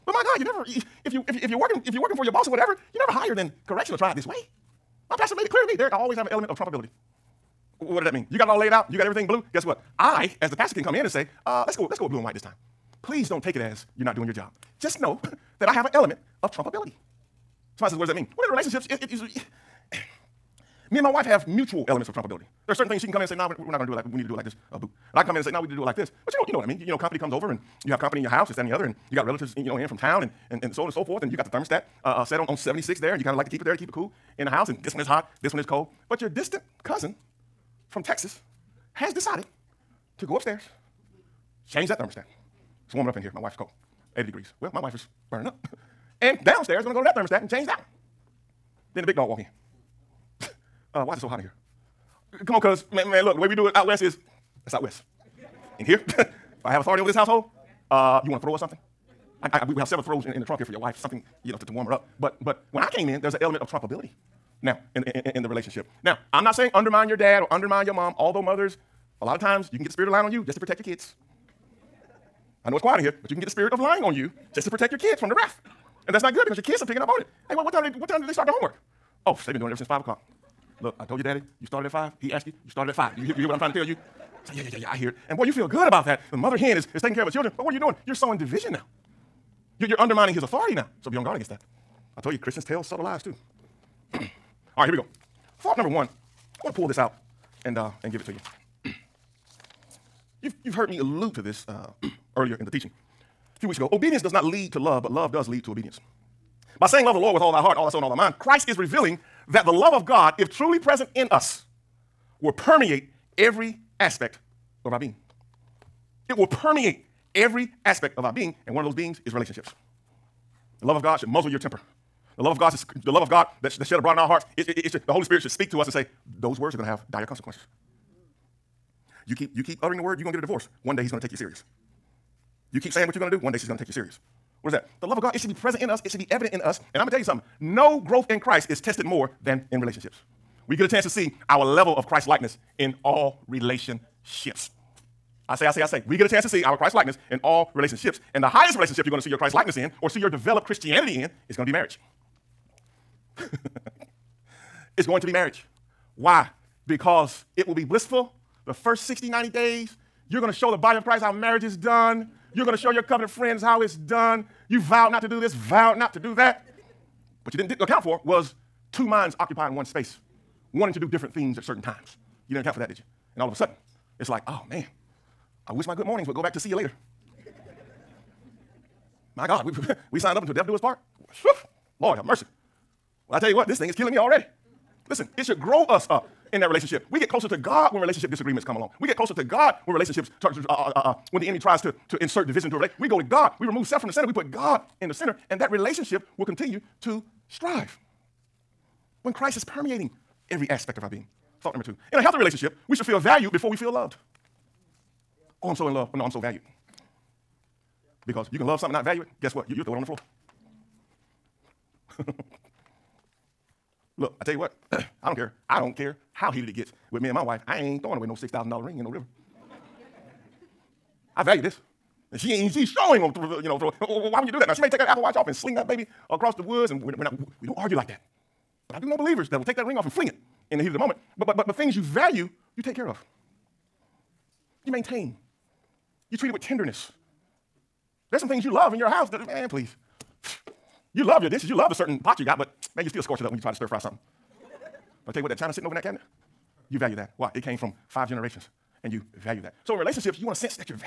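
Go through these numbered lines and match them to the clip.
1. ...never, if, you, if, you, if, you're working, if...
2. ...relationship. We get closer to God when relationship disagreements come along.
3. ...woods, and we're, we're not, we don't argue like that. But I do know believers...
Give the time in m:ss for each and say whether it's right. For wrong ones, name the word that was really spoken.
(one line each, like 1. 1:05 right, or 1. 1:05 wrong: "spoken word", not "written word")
1. 0:00 right
2. 3:06 right
3. 3:46 right.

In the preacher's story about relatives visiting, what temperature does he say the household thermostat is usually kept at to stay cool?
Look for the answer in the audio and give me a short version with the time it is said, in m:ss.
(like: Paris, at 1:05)
76, at 0:32.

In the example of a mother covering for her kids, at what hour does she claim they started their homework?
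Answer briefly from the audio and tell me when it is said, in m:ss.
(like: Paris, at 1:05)
5 o'clock, at 1:19.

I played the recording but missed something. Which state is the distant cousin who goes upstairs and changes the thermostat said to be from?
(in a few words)
Texas.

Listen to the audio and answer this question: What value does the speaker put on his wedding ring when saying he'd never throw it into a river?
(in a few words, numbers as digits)
$6,000.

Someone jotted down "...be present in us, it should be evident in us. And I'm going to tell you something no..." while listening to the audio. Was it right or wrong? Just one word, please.
right.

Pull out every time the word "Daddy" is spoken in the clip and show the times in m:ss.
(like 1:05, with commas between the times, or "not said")
1:21.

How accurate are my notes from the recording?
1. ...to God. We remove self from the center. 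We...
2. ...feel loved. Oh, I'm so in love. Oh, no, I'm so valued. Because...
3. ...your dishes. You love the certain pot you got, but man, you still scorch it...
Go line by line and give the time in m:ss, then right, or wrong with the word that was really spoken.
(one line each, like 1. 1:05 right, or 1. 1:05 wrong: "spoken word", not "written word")
1. 3:13 right
2. 3:23 right
3. 4:01 right.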